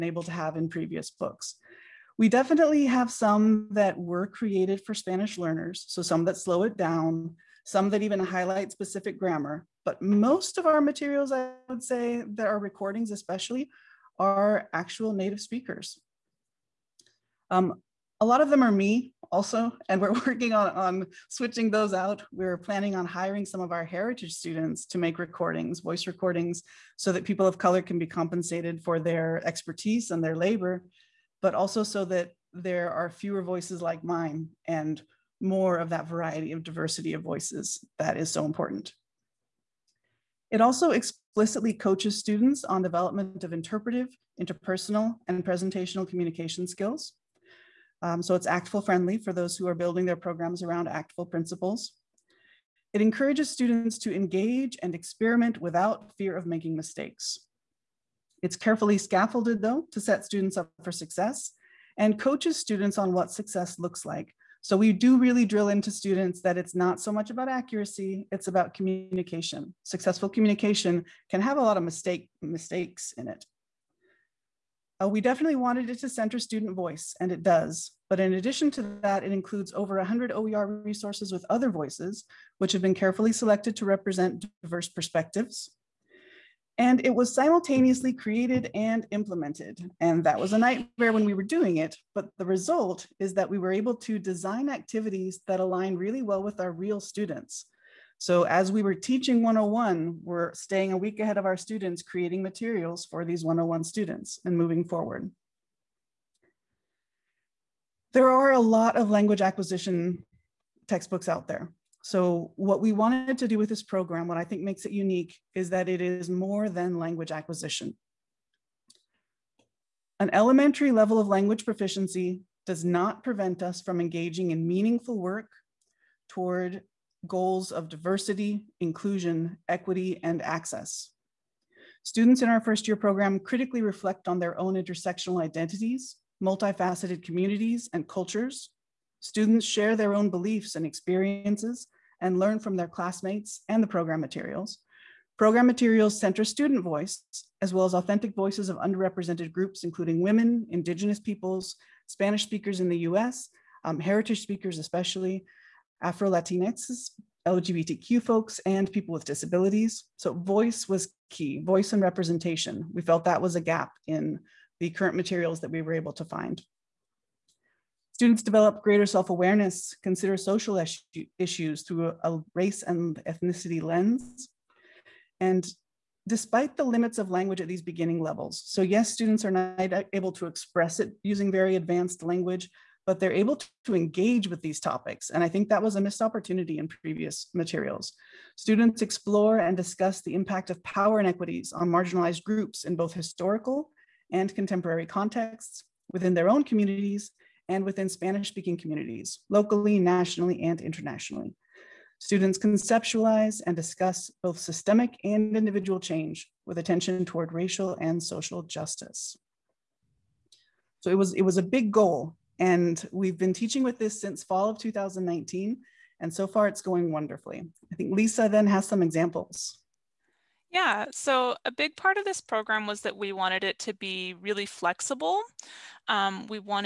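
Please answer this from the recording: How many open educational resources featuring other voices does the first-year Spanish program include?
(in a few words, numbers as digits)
over 100.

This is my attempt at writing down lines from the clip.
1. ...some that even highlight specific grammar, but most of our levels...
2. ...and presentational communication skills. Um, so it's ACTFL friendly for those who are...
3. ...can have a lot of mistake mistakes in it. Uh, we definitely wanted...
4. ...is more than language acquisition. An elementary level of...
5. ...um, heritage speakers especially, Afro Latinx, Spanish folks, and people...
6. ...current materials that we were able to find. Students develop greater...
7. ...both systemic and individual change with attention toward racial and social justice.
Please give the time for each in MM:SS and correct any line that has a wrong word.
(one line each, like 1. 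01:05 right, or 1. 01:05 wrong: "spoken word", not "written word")
1. 00:07 wrong: "materials", not "levels"
2. 00:45 right
3. 01:11 right
4. 01:55 right
5. 02:33 wrong: "LGBTQ", not "Spanish"
6. 02:44 right
7. 03:24 right.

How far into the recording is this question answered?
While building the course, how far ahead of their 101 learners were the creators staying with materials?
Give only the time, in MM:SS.
01:40.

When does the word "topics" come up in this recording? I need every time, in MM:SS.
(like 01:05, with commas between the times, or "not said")
03:04.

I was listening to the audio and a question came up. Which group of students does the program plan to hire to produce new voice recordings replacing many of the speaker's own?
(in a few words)
heritage students.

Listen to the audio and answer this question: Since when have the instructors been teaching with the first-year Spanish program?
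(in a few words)
fall of 2019.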